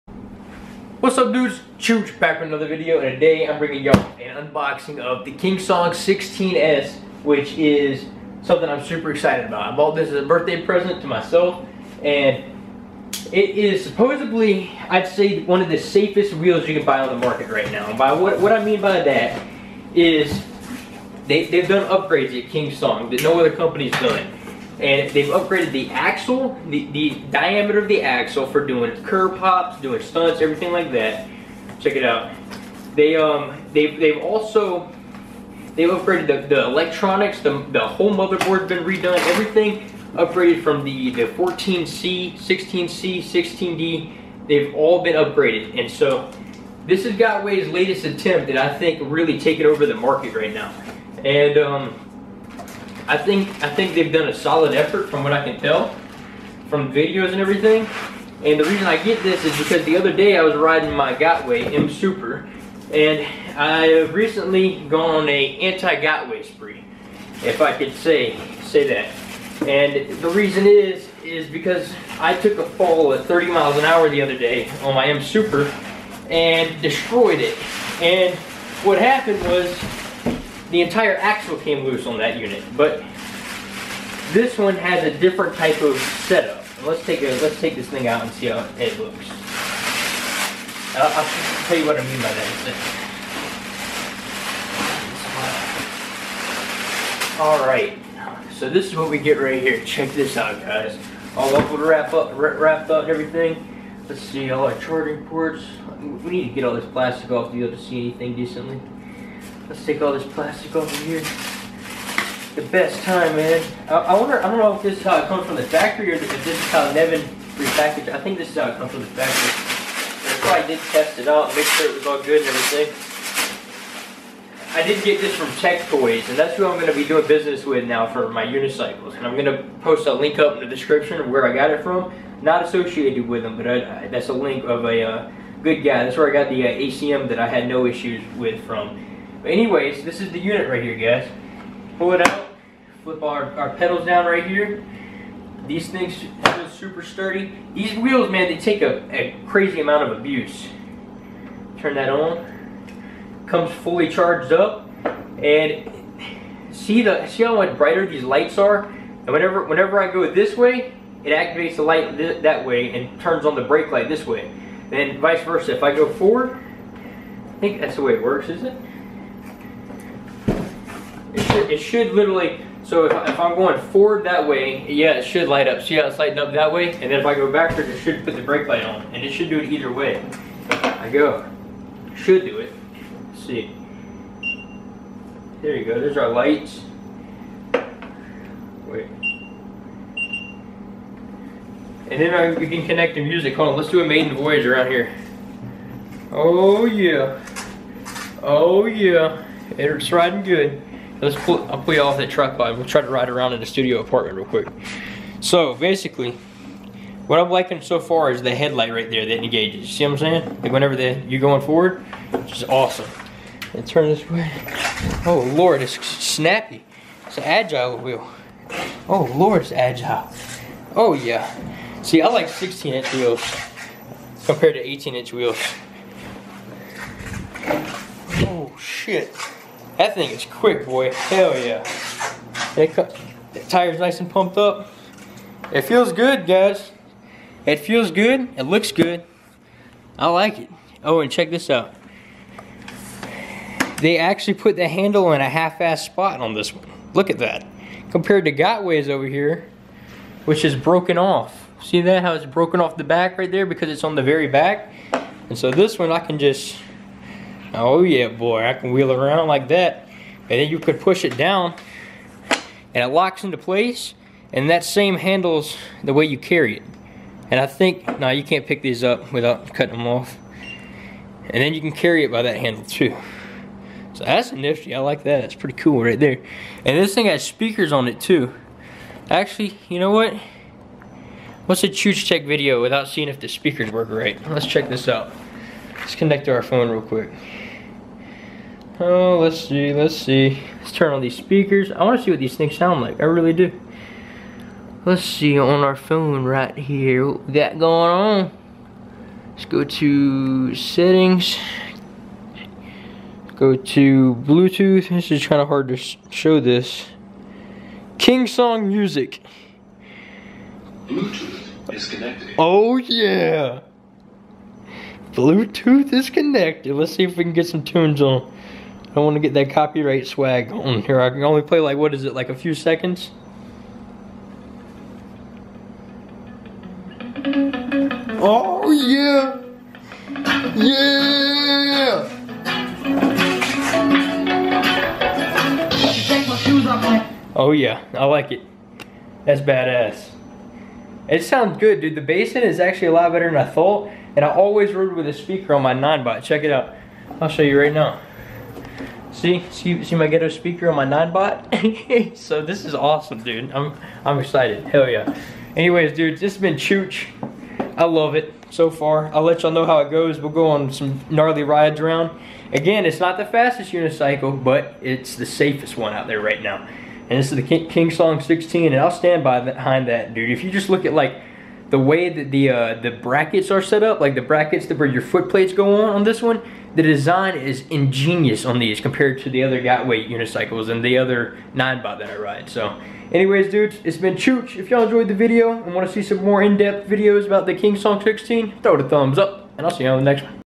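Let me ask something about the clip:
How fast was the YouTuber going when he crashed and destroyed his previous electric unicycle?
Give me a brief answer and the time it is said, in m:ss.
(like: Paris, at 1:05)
30 miles an hour, at 1:13.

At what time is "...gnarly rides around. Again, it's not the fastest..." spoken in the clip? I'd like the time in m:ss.
6:01.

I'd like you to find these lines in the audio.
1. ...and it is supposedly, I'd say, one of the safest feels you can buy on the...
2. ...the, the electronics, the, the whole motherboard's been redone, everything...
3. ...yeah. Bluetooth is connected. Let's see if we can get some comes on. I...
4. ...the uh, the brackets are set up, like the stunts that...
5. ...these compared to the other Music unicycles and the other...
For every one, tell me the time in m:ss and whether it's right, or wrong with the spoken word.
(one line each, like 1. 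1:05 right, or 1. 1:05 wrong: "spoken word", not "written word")
1. 0:12 wrong: "wheels", not "feels"
2. 0:36 right
3. 5:12 wrong: "tunes", not "comes"
4. 6:12 wrong: "brackets", not "stunts"
5. 6:18 wrong: "Gotway", not "Music".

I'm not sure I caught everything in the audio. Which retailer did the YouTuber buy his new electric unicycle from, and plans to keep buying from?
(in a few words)
Tech Toys.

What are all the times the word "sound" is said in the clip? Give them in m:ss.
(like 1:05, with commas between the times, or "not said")
4:52, 5:41.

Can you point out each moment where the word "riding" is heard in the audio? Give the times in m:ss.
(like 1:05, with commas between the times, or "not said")
1:00, 3:20.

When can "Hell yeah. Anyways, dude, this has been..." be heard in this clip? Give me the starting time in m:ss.
5:54.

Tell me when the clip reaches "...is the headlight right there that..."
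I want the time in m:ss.
3:28.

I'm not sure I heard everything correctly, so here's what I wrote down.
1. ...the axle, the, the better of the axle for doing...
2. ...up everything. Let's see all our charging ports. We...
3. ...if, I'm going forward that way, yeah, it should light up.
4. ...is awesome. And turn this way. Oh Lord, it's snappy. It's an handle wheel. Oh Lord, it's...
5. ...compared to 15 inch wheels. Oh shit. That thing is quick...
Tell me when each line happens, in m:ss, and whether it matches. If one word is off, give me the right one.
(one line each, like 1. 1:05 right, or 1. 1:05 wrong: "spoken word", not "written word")
1. 0:25 wrong: "diameter", not "better"
2. 1:42 right
3. 2:53 right
4. 3:32 wrong: "agile", not "handle"
5. 3:44 wrong: "18", not "15".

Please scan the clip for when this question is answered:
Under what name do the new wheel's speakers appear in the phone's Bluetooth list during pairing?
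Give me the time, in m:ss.
5:08.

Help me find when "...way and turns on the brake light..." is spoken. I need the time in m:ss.
2:42.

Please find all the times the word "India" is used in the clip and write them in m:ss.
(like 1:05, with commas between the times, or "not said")
not said.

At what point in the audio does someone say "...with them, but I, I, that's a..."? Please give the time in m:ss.
2:13.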